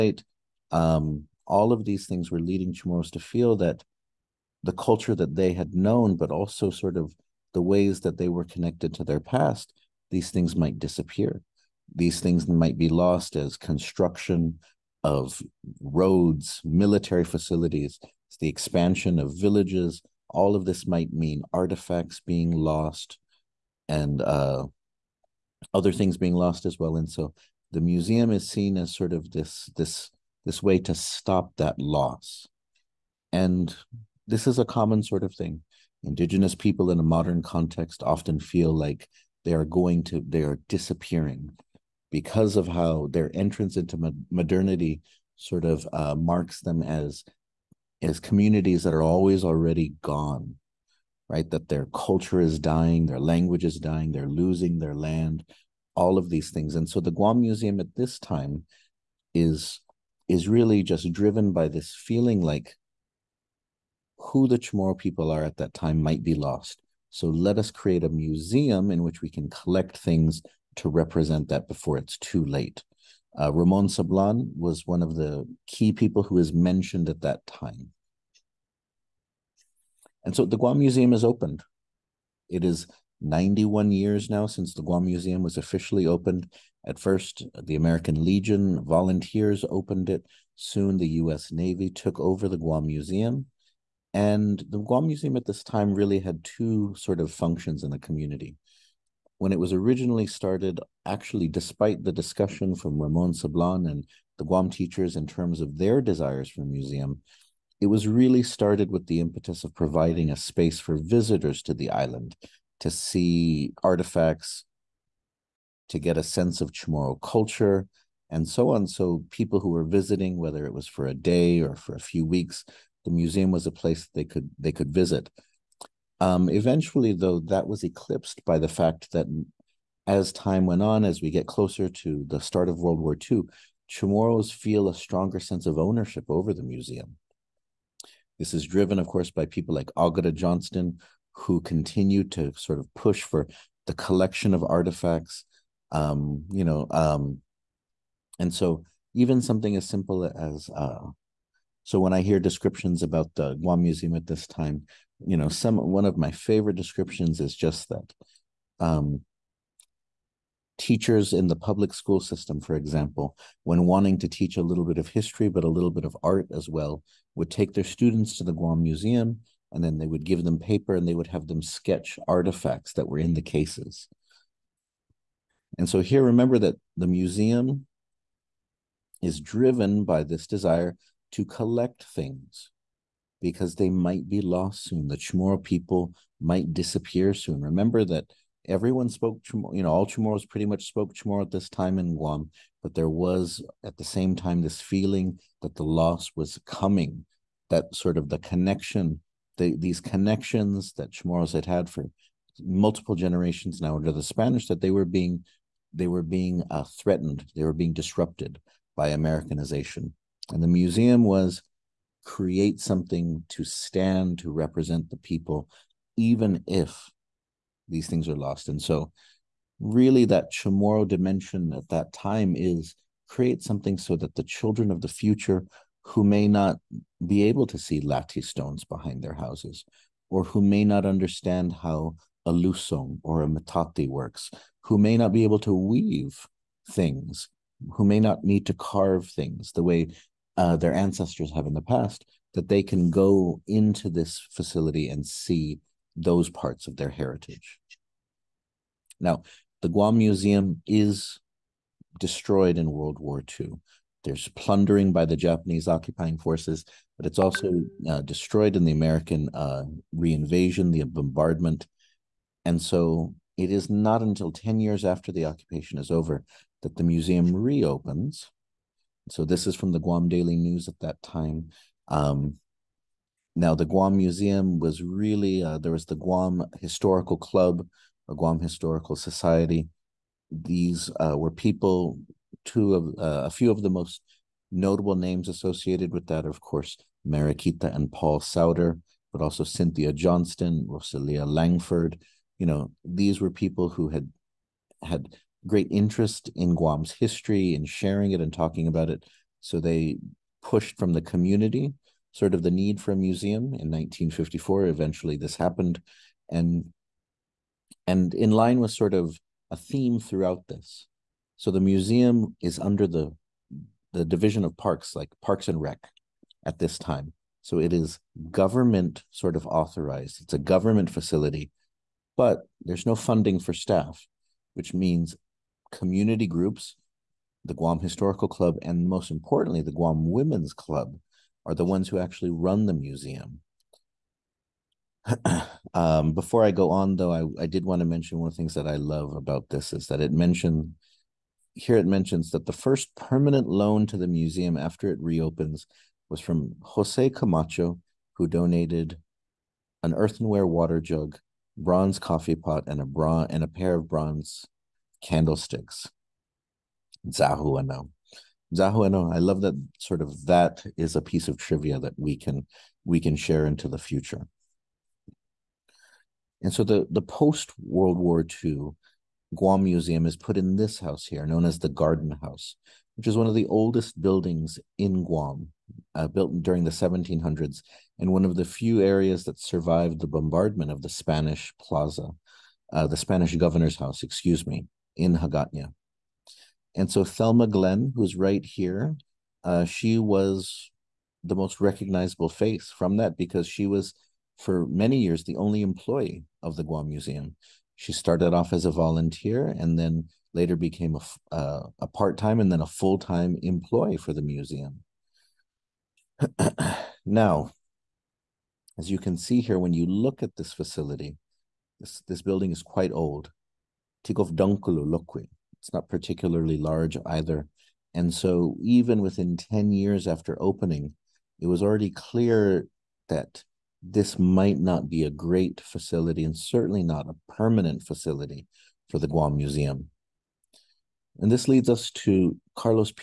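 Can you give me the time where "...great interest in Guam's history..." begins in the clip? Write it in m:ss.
4:55.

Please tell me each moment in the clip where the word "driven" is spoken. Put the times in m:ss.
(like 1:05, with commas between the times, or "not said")
1:01, 2:18, 2:59.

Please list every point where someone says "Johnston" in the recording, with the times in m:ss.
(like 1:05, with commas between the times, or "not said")
2:20, 4:50.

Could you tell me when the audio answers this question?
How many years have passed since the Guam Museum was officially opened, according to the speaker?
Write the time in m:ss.
1:23.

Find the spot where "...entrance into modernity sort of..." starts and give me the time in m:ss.
0:43.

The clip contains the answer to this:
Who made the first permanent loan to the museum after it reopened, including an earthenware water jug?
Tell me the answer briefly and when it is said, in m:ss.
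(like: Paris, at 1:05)
Jose Camacho, at 5:46.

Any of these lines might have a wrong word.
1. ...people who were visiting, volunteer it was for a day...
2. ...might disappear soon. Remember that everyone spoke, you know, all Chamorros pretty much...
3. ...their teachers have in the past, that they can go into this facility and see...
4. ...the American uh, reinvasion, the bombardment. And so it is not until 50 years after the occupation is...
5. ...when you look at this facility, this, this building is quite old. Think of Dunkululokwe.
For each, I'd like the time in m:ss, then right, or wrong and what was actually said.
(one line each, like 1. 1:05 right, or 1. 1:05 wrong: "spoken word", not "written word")
1. 1:59 wrong: "whether", not "volunteer"
2. 3:06 right
3. 4:00 wrong: "ancestors", not "teachers"
4. 4:18 wrong: "10", not "50"
5. 6:49 right.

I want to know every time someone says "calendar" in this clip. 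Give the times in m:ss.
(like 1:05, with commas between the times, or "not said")
not said.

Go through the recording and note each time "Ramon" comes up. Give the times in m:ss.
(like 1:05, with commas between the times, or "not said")
1:13, 1:43.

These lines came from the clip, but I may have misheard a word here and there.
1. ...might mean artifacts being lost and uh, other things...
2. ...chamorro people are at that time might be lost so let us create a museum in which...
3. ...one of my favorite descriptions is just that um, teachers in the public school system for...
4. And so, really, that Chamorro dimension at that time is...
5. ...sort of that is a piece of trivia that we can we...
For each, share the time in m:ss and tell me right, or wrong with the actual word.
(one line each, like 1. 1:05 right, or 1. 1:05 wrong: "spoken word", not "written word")
1. 0:20 right
2. 1:04 right
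3. 2:35 right
4. 3:38 right
5. 5:59 right.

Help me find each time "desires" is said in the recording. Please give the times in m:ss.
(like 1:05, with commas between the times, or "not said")
1:46, 3:00.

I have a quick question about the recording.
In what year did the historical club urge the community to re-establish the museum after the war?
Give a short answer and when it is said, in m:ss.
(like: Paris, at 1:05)
1954, at 5:03.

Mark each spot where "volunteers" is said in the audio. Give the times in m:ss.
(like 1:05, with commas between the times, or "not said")
1:28, 6:38.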